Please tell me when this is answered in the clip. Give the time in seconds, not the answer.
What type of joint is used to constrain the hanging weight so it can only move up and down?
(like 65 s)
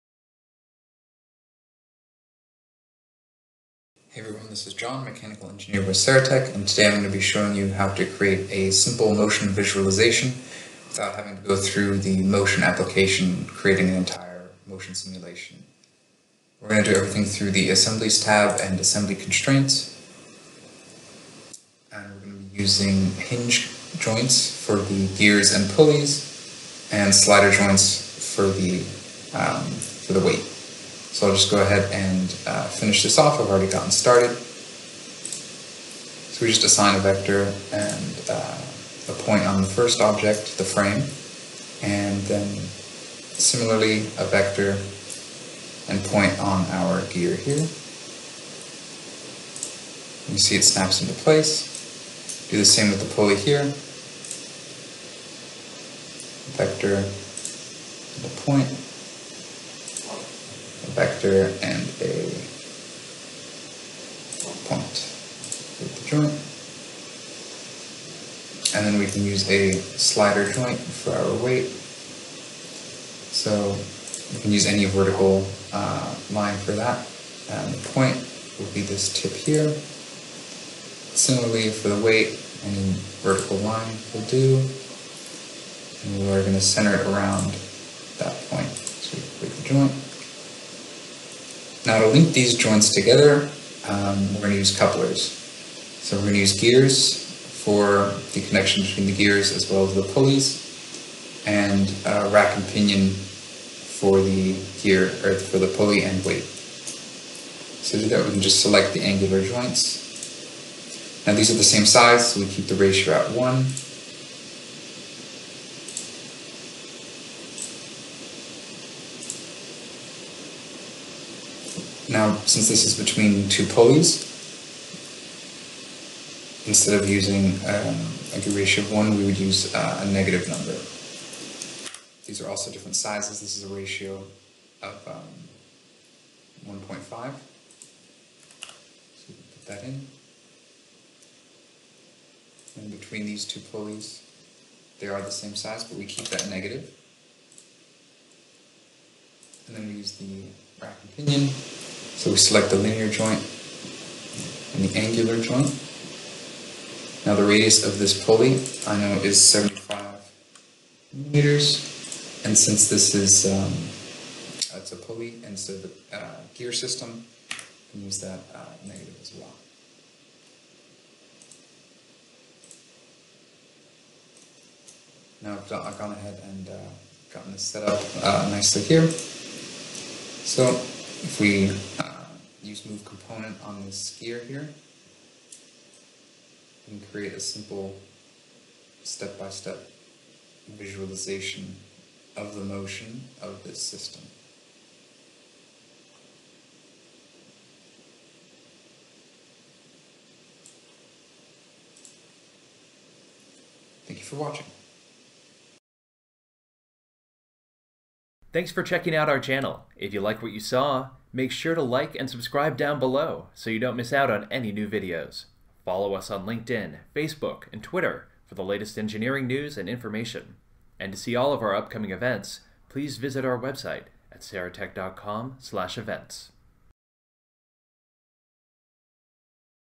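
69 s.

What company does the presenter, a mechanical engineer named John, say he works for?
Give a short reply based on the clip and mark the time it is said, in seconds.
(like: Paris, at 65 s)
Saratech, at 5 s.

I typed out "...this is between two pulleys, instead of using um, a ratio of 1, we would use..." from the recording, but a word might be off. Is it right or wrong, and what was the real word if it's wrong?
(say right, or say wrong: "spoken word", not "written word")
right.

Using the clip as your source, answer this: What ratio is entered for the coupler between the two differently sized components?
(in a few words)
1.5.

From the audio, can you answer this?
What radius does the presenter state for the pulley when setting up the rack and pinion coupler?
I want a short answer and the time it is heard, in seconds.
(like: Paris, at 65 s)
75 meters, at 159 s.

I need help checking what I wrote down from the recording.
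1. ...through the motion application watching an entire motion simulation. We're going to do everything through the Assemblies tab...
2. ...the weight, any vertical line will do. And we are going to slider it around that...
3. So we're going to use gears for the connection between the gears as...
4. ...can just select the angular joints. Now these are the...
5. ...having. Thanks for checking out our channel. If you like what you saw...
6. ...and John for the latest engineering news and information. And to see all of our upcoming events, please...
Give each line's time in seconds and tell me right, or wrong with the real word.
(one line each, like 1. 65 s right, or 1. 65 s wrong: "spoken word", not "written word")
1. 11 s wrong: "creating", not "watching"
2. 81 s wrong: "center", not "slider"
3. 95 s right
4. 108 s right
5. 204 s wrong: "watching", not "having"
6. 217 s wrong: "Twitter", not "John".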